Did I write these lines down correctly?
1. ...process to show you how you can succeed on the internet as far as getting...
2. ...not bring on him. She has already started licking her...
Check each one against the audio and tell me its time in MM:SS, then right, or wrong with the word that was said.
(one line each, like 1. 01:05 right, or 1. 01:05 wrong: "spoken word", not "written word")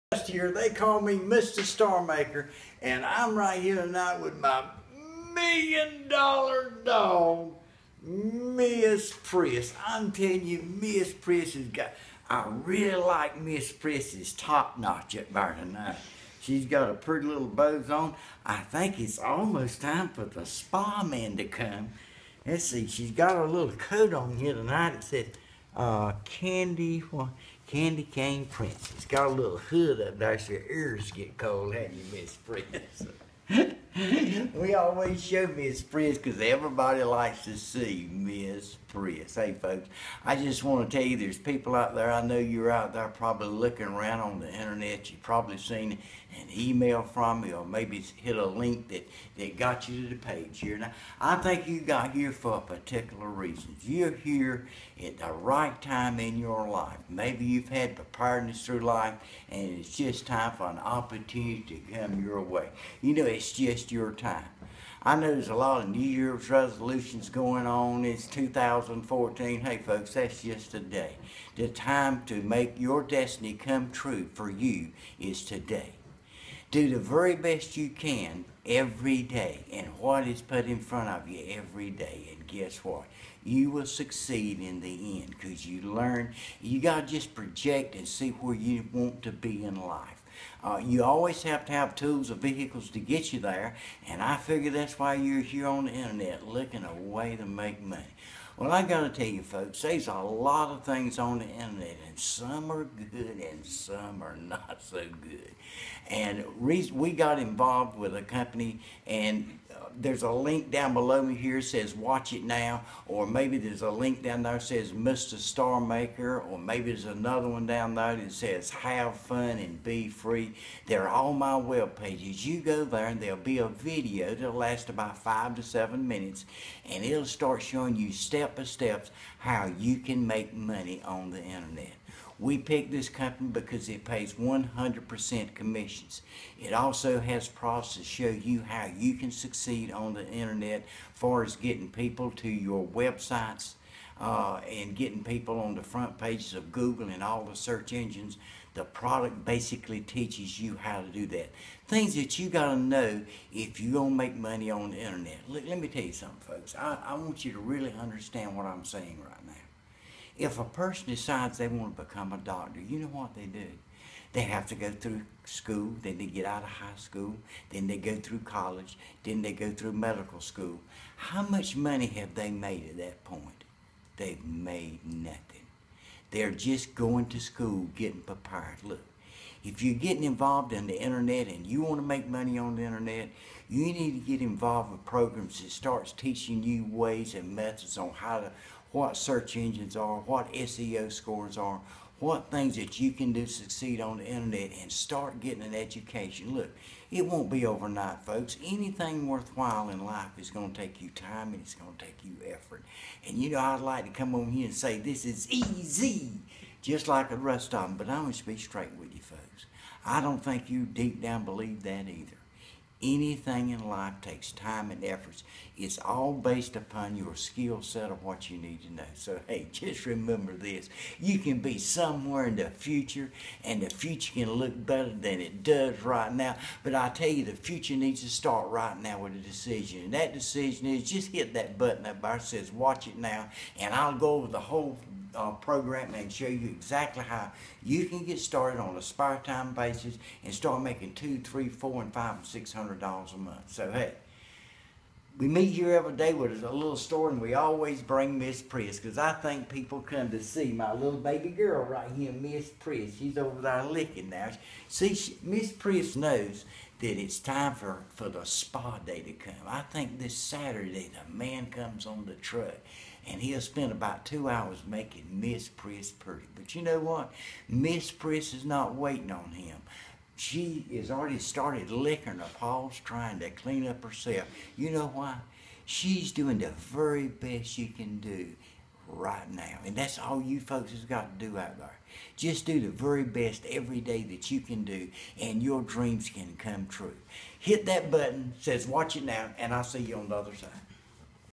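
1. 02:17 right
2. 04:28 wrong: "waiting", not "bring".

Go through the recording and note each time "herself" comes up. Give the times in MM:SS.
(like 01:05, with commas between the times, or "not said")
04:34.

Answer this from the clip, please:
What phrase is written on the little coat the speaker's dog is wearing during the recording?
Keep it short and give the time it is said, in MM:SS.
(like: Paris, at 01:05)
Candy Cane Princess, at 00:26.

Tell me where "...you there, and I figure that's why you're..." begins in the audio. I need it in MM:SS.
01:33.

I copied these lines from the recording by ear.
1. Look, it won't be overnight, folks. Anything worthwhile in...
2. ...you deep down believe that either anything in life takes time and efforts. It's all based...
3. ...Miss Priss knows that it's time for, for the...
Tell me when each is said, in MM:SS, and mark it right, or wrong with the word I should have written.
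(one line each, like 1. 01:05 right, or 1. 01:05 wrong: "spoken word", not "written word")
1. 03:16 right
2. 03:30 right
3. 04:15 right.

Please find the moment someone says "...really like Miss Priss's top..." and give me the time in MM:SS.
00:12.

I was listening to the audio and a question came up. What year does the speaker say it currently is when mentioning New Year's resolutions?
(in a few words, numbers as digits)
2014.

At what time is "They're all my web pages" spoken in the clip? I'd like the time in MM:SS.
02:00.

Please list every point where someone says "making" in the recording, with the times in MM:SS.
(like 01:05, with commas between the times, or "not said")
04:00, 04:24.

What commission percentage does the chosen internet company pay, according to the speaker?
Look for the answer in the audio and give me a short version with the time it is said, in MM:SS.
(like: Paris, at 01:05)
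100%, at 02:14.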